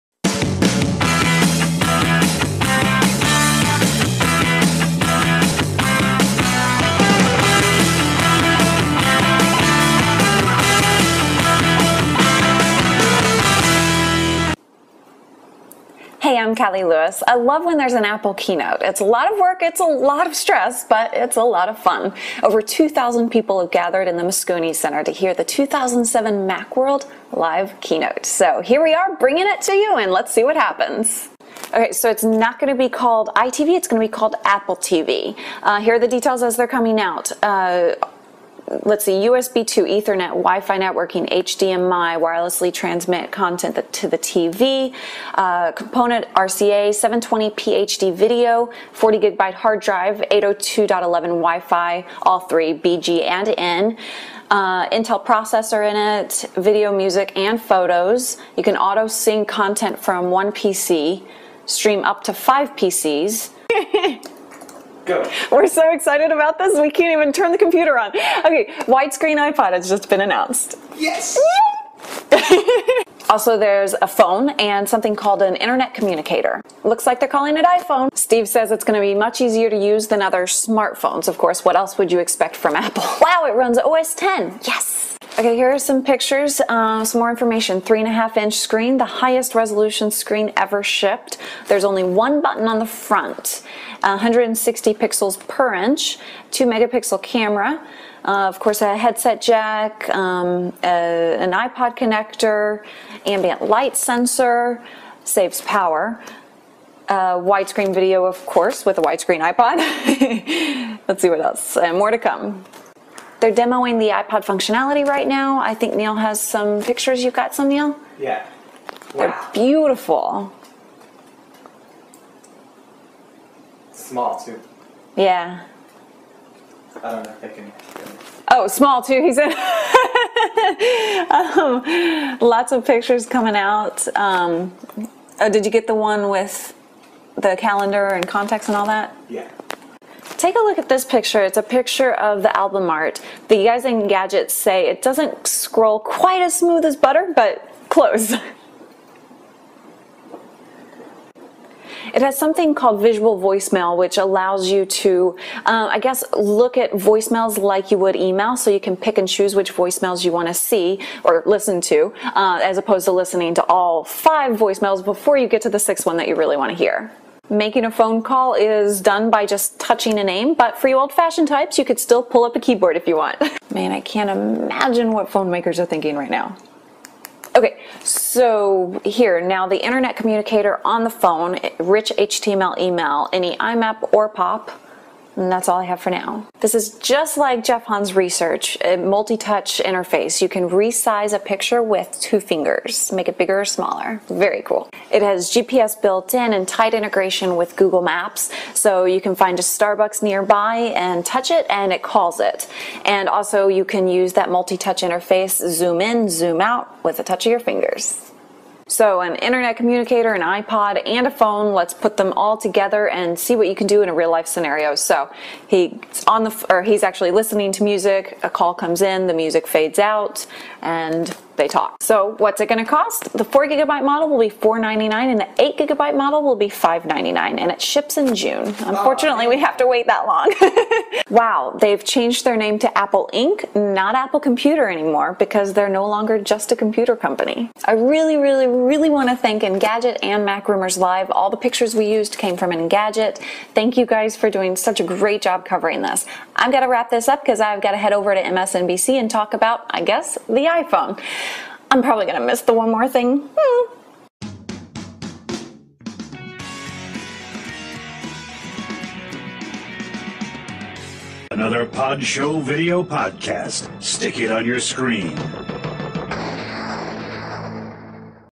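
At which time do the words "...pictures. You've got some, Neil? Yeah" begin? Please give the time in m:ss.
1:56.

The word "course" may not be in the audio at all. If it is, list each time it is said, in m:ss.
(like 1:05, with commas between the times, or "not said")
1:21, 1:38, 1:48.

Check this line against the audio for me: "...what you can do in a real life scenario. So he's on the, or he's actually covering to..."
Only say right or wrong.
wrong.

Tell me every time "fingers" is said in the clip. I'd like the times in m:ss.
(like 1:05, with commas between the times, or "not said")
3:12, 3:27.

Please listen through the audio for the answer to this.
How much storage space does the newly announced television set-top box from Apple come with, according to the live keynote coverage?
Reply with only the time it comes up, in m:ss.
0:48.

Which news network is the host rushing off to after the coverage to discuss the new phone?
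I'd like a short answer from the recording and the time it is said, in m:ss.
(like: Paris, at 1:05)
MSNBC, at 4:08.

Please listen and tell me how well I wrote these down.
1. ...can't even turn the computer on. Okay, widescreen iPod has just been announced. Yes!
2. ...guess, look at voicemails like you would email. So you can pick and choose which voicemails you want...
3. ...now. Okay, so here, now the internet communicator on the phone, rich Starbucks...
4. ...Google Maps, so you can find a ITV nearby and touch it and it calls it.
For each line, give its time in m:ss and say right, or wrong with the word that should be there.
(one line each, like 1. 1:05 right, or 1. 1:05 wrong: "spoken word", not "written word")
1. 1:06 right
2. 2:35 right
3. 2:56 wrong: "HTML", not "Starbucks"
4. 3:17 wrong: "Starbucks", not "ITV".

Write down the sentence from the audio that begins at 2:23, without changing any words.
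The guys in Gadgets say it doesn't scroll quite as smooth as butter, but close.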